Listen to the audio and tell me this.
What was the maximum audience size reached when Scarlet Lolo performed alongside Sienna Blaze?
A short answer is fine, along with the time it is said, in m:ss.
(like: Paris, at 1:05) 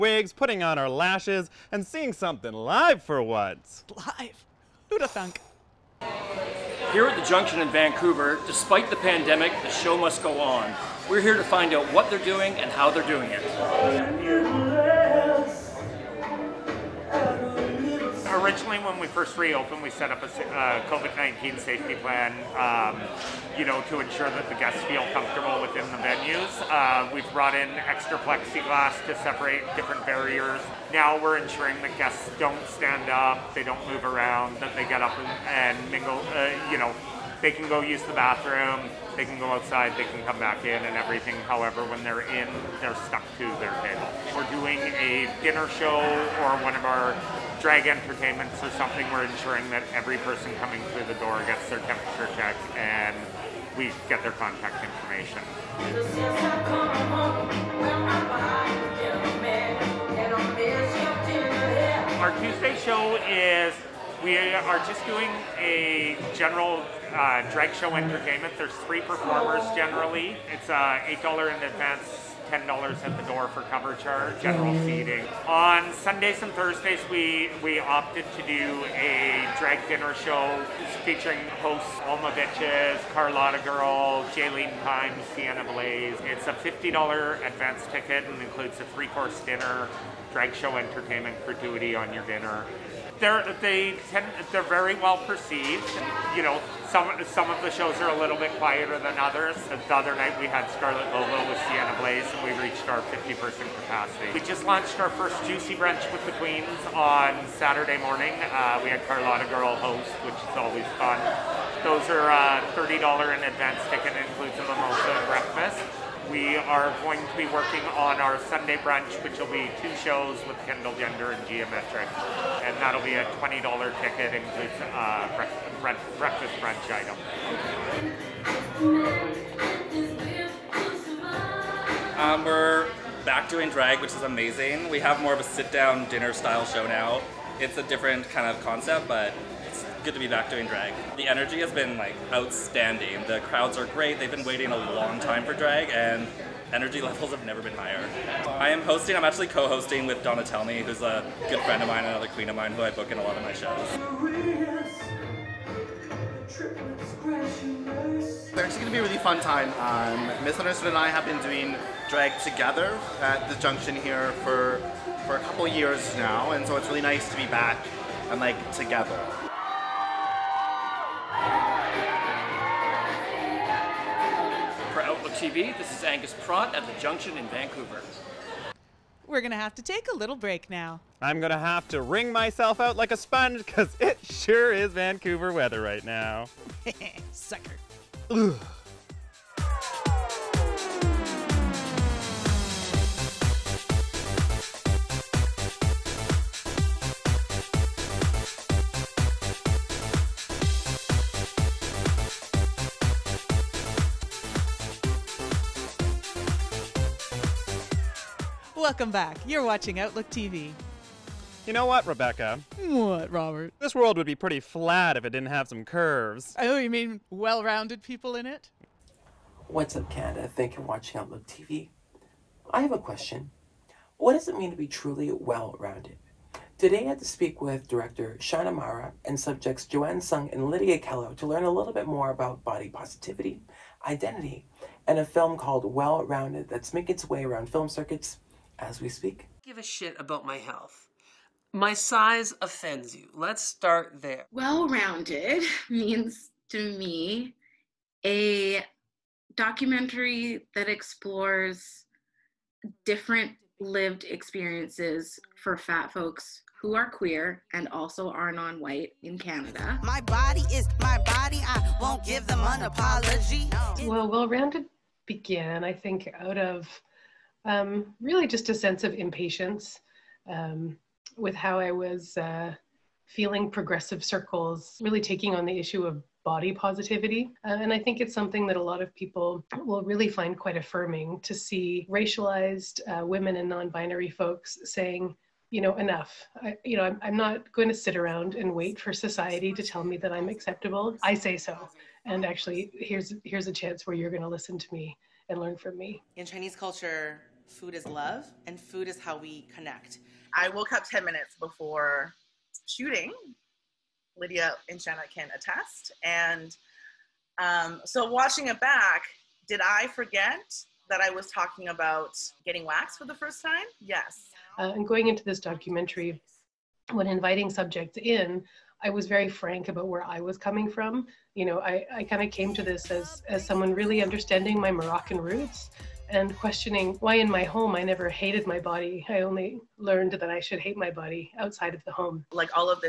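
50, at 1:42.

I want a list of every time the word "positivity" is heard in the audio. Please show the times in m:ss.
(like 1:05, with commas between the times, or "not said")
3:52, 4:36.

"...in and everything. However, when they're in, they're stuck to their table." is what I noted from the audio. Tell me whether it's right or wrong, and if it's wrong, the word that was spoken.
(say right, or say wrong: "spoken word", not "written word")
right.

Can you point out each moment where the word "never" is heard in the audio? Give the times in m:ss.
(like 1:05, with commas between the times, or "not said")
2:27, 5:28.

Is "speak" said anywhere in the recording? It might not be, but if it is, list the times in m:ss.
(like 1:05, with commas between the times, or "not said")
3:47, 3:59.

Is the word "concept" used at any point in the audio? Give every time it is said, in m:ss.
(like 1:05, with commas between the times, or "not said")
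2:18.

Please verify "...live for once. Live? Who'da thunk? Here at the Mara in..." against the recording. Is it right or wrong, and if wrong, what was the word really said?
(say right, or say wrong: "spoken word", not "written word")
wrong: "Junction", not "Mara".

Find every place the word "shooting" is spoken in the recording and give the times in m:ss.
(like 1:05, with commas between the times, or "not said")
5:02.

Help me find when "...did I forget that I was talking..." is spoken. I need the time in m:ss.
5:09.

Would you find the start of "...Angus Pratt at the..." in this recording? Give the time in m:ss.
2:56.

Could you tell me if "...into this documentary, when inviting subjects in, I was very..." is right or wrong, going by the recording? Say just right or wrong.
right.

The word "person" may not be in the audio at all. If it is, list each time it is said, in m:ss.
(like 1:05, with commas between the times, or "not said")
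0:50, 1:43.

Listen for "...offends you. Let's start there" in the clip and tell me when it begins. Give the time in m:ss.
4:02.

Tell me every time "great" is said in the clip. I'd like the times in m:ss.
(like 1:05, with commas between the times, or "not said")
2:23.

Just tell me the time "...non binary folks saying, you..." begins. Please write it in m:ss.
4:43.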